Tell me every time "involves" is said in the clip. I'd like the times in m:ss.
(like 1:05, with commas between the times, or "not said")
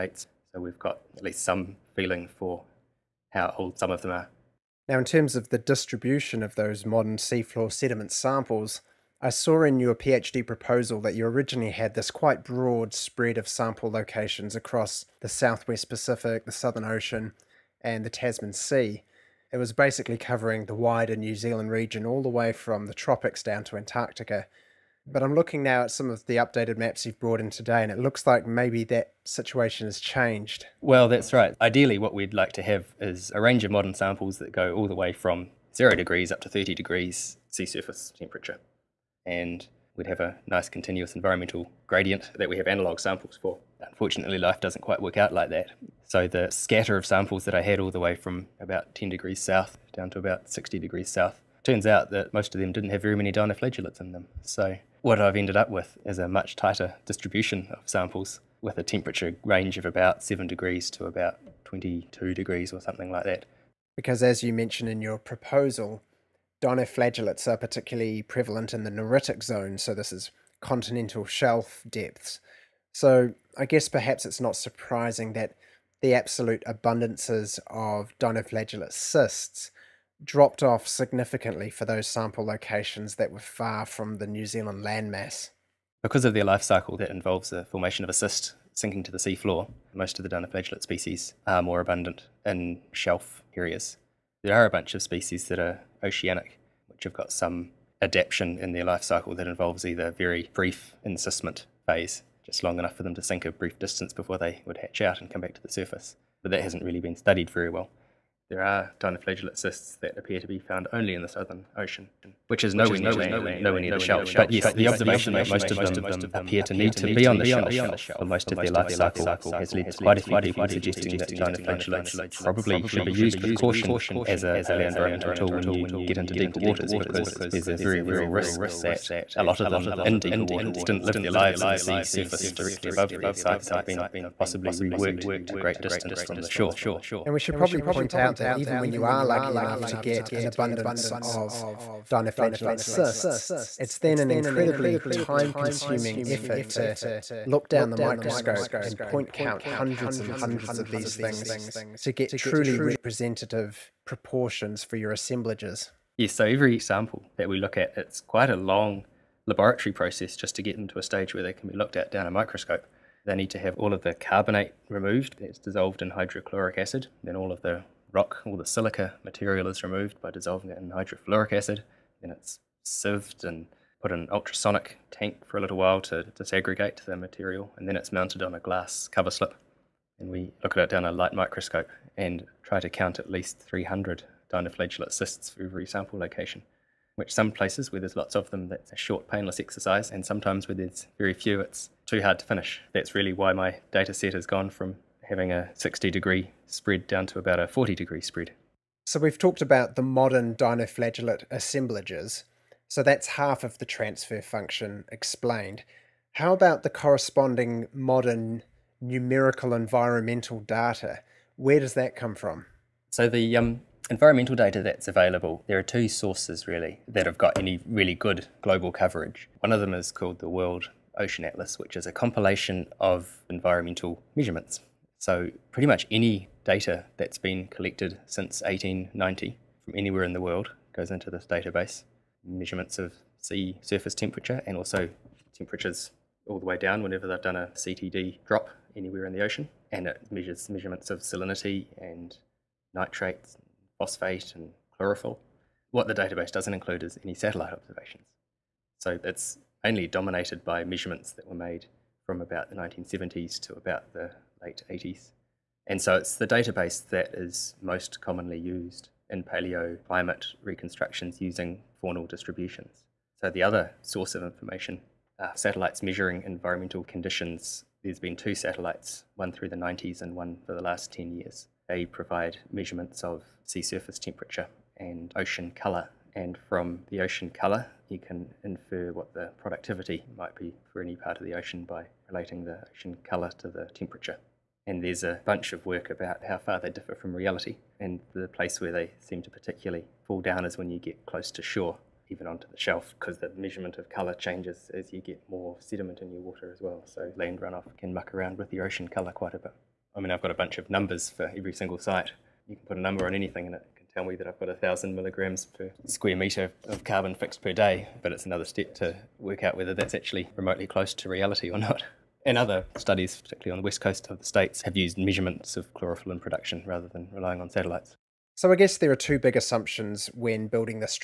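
1:27, 1:39.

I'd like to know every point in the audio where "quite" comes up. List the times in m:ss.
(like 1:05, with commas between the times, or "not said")
0:12, 0:44, 1:59, 2:38, 4:59.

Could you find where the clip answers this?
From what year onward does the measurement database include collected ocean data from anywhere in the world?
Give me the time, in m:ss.
3:48.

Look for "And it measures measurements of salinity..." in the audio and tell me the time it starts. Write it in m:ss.
3:59.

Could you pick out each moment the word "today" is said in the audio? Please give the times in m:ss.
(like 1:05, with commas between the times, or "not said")
0:27.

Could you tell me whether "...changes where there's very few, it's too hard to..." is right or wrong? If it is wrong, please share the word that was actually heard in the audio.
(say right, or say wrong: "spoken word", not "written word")
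wrong: "sometimes", not "changes".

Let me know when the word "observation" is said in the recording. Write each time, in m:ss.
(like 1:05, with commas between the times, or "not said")
1:54, 4:07.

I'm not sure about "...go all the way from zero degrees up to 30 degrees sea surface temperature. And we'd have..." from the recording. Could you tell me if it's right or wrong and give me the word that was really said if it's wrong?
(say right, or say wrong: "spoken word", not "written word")
right.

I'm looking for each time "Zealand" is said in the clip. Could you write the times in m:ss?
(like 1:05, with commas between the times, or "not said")
0:21, 1:24.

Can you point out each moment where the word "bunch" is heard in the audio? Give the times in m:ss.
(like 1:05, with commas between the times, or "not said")
1:34, 4:45, 5:00.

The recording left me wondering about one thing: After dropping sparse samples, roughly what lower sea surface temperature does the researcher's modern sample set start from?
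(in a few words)
7 degrees.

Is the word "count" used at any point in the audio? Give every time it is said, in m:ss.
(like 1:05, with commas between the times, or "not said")
2:29, 3:02.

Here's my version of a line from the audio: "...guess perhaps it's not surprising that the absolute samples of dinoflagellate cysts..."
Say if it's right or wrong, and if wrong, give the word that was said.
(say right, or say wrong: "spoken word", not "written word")
wrong: "abundances", not "samples".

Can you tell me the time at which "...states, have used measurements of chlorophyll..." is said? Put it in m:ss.
5:14.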